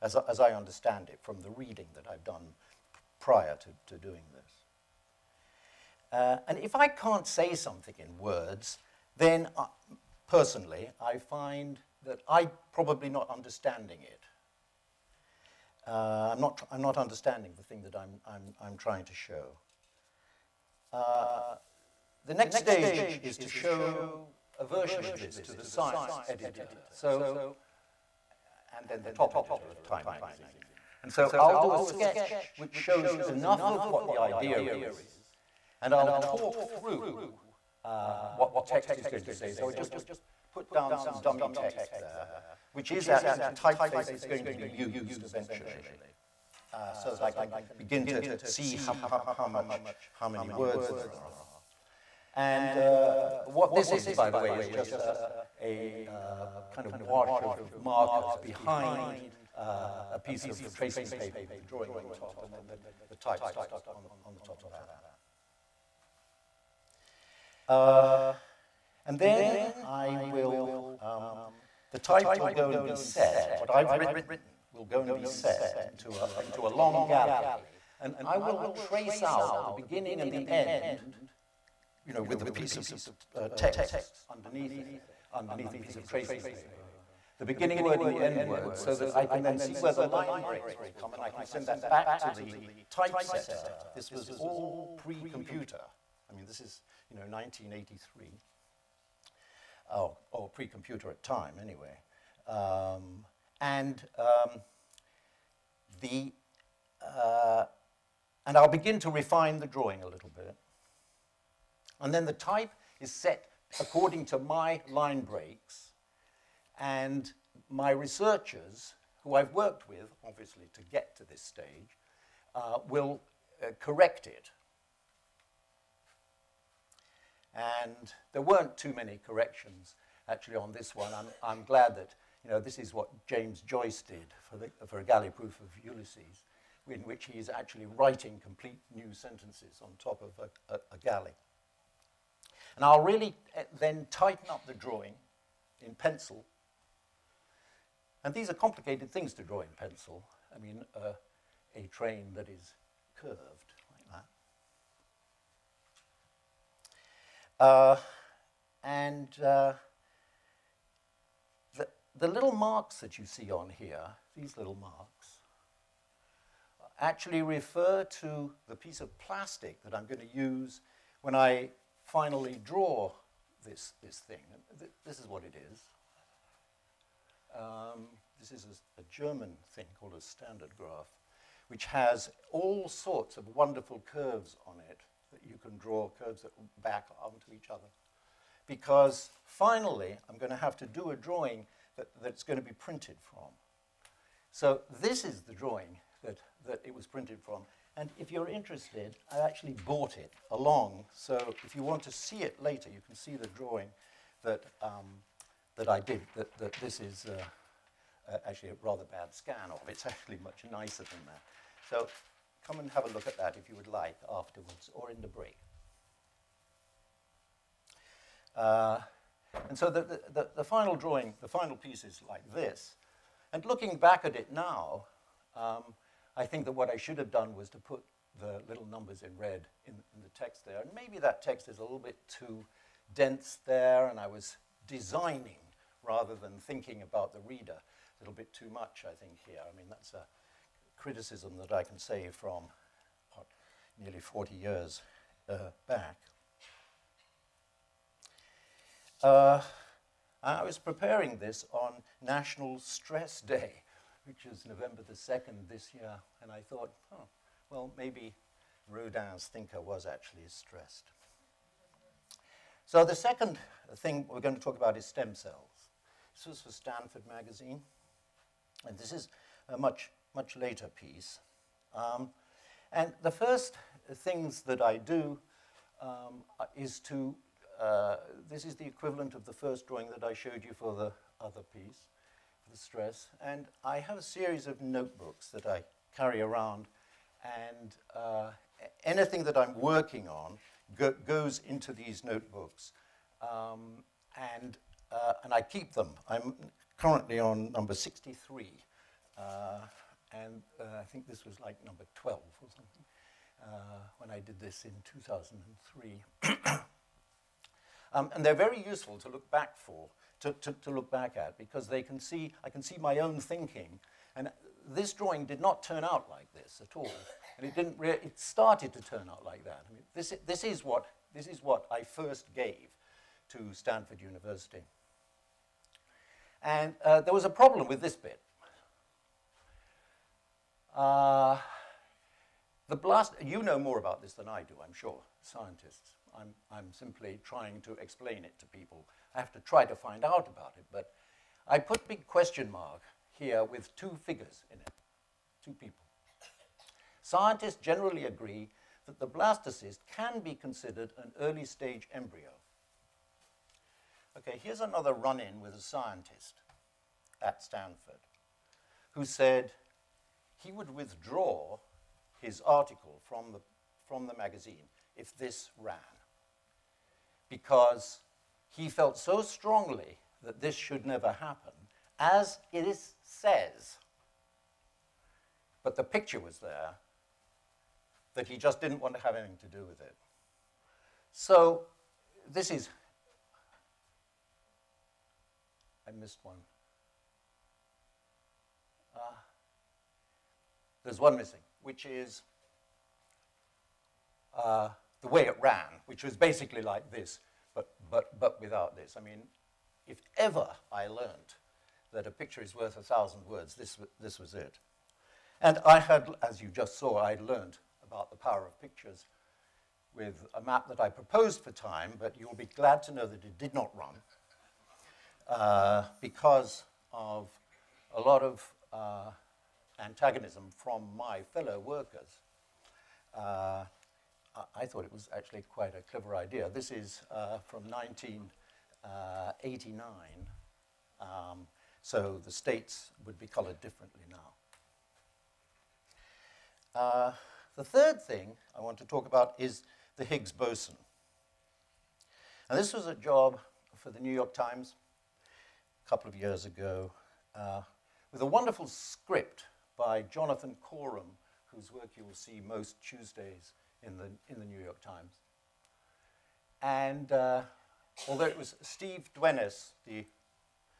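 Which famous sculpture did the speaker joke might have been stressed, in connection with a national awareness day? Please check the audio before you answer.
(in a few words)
Rodin's thinker.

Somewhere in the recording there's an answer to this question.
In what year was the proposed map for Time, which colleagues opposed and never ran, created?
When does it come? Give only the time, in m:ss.
7:07.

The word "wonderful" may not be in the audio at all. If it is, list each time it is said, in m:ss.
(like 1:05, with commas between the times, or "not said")
3:03, 7:28.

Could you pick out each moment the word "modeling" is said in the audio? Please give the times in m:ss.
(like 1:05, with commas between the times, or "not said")
not said.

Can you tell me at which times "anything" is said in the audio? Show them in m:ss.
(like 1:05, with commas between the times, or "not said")
4:49, 6:19.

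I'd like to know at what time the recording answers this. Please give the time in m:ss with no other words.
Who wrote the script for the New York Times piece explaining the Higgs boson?
7:30.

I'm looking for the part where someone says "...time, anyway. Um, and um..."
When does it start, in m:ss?
1:41.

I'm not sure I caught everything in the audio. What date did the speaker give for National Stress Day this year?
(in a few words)
November 2nd.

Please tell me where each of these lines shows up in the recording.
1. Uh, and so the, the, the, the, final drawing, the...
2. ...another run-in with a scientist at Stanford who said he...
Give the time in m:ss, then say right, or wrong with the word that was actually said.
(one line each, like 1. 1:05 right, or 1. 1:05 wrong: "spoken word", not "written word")
1. 3:38 right
2. 5:54 right.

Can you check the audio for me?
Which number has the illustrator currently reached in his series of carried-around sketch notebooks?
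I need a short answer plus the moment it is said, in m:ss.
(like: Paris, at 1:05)
63, at 4:57.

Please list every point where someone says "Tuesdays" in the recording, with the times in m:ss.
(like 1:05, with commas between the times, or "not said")
7:33.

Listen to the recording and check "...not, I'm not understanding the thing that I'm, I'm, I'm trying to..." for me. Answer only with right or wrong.
right.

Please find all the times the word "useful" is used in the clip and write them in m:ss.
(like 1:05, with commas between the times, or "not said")
5:08.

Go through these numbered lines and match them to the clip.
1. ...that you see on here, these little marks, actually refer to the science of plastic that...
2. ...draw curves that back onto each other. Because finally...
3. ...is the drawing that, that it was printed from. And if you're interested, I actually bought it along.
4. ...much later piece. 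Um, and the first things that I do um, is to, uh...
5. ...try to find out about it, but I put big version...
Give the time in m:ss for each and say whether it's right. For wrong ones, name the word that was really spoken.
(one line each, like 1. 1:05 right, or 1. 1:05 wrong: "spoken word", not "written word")
1. 2:42 wrong: "piece", not "science"
2. 3:05 right
3. 3:15 right
4. 4:30 right
5. 5:39 wrong: "question", not "version".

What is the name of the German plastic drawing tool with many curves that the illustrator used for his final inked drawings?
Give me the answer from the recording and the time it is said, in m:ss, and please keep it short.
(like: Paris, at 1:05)
Standardgraph, at 3:00.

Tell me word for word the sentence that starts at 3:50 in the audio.
And maybe that text is a little bit too dense there, and I was designing rather than thinking about the reader.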